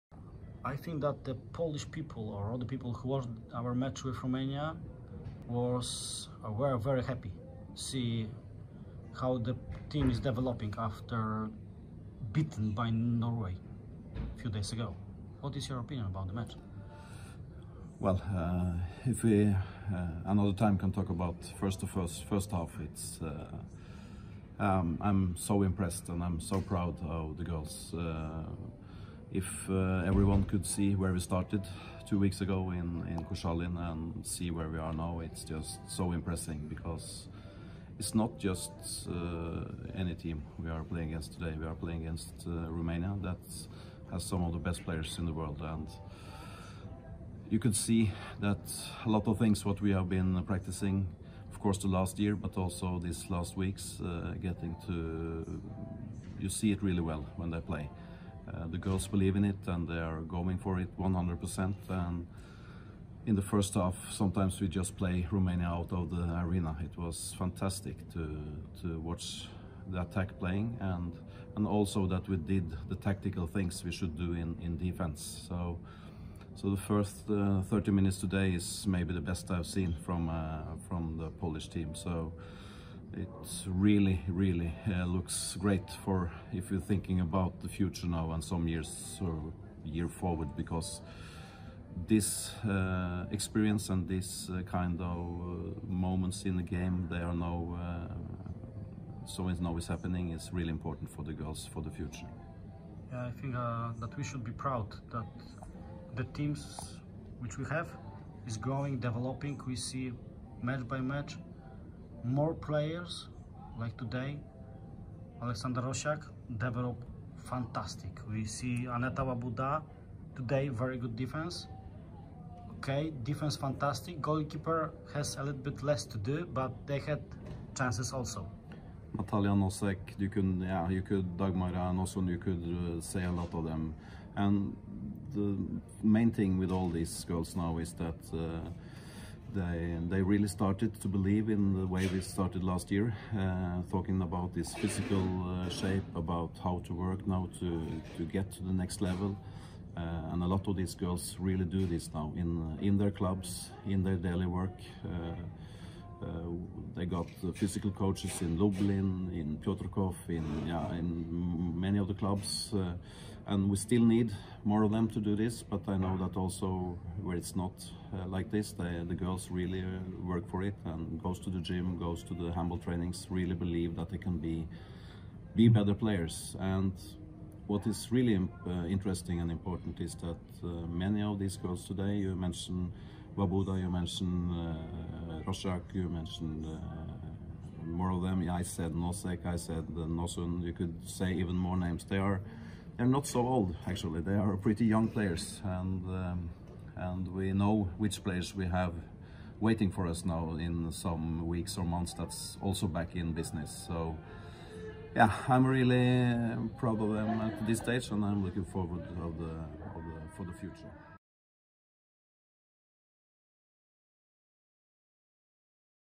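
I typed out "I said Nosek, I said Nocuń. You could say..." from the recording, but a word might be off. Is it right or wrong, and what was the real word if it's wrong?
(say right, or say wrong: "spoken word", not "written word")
right.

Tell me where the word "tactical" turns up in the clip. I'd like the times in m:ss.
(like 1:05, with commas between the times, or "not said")
1:12.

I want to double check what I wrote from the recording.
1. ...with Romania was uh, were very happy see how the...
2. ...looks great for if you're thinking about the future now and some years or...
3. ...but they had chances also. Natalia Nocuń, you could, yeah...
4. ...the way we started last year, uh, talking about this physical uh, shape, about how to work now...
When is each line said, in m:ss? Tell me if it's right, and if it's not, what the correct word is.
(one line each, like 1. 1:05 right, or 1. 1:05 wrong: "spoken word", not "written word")
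1. 0:04 right
2. 1:25 right
3. 2:06 wrong: "Nosek", not "Nocuń"
4. 2:21 right.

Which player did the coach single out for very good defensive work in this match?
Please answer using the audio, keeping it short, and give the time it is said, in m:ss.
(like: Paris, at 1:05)
Aneta Łabuda, at 1:58.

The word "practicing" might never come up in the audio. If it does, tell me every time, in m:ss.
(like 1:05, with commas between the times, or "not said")
0:50.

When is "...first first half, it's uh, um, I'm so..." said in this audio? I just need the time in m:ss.
0:21.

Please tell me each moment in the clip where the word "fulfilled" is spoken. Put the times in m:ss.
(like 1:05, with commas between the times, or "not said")
not said.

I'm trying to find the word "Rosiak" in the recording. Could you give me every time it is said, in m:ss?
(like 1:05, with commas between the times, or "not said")
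1:55, 3:05.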